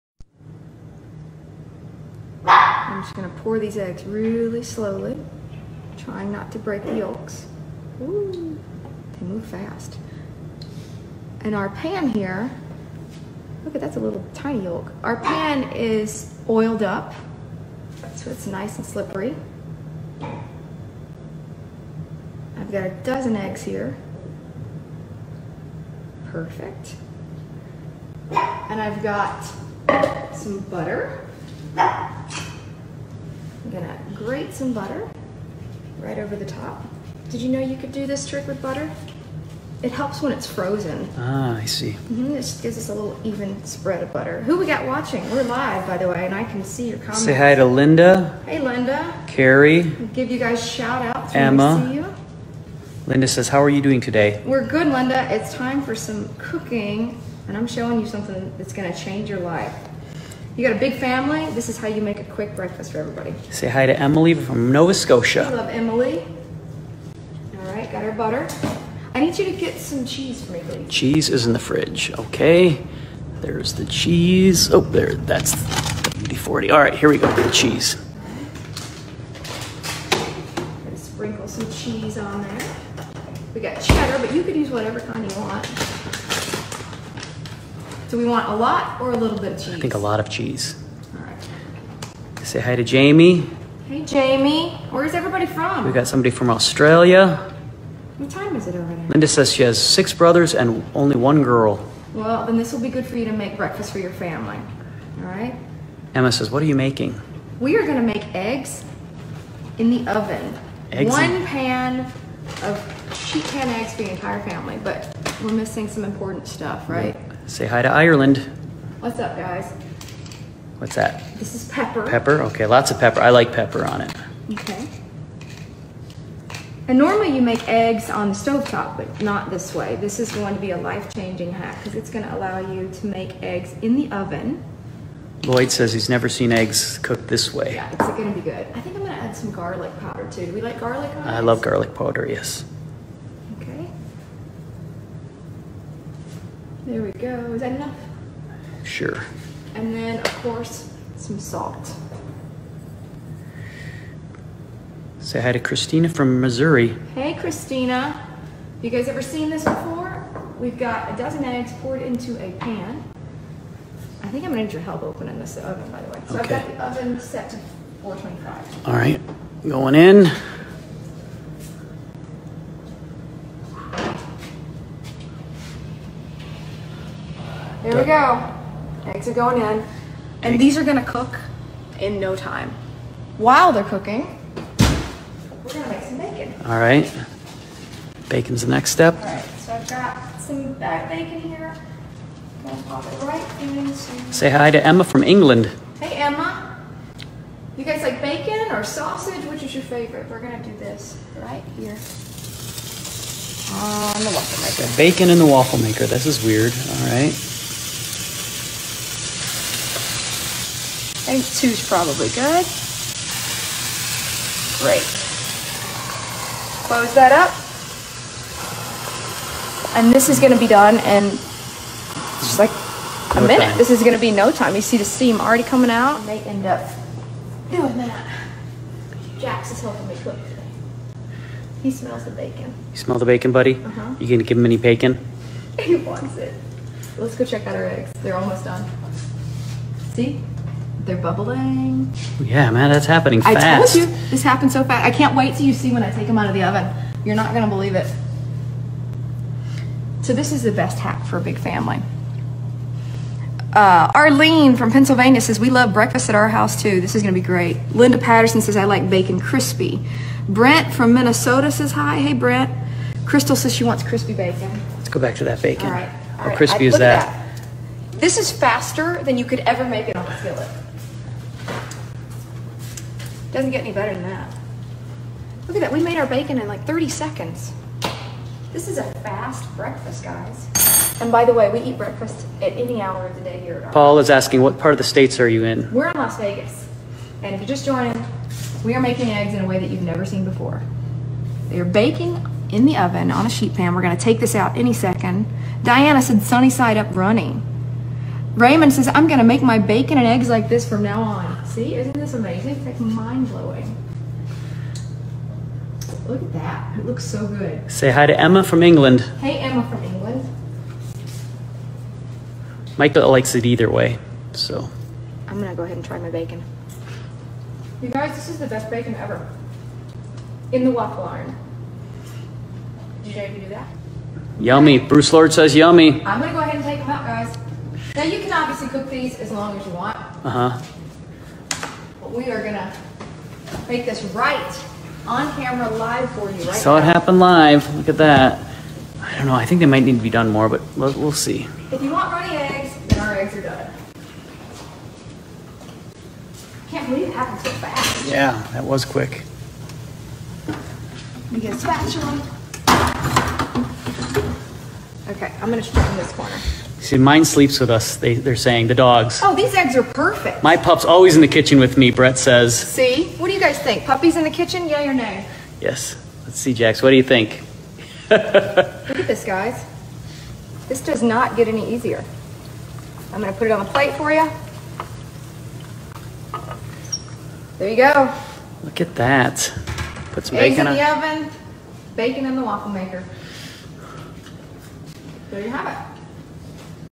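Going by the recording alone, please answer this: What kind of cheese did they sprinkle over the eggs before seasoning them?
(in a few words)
cheddar.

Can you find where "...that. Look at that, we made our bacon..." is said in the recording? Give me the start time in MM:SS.
04:34.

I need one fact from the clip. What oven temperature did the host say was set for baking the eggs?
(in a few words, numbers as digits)
425.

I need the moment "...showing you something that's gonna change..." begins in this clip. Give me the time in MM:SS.
00:57.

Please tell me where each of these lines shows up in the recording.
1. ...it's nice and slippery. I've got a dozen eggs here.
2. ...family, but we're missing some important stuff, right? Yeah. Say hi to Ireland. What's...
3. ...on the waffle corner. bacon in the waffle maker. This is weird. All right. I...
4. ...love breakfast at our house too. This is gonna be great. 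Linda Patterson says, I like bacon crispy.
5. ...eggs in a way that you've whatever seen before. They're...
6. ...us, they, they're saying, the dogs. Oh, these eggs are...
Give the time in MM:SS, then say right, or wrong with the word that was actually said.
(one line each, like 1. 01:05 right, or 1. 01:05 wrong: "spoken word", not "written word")
1. 00:18 right
2. 01:54 right
3. 03:23 wrong: "maker", not "corner"
4. 04:15 right
5. 04:49 wrong: "never", not "whatever"
6. 05:57 right.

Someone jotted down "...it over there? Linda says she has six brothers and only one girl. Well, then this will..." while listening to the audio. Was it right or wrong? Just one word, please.
right.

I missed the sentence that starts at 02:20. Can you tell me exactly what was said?
Do we like garlic I eggs?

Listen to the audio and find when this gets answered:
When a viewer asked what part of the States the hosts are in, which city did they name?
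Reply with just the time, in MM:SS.
04:46.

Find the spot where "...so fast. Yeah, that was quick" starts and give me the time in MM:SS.
05:47.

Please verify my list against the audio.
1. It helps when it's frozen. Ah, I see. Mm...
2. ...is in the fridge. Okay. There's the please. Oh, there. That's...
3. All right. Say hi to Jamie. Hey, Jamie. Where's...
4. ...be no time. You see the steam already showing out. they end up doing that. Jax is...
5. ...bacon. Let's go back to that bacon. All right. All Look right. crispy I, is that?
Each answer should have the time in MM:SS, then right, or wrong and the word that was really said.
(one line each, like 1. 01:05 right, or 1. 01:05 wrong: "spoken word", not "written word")
1. 00:39 right
2. 01:11 wrong: "cheese", not "please"
3. 01:31 right
4. 03:44 wrong: "coming", not "showing"
5. 04:24 wrong: "How", not "Look".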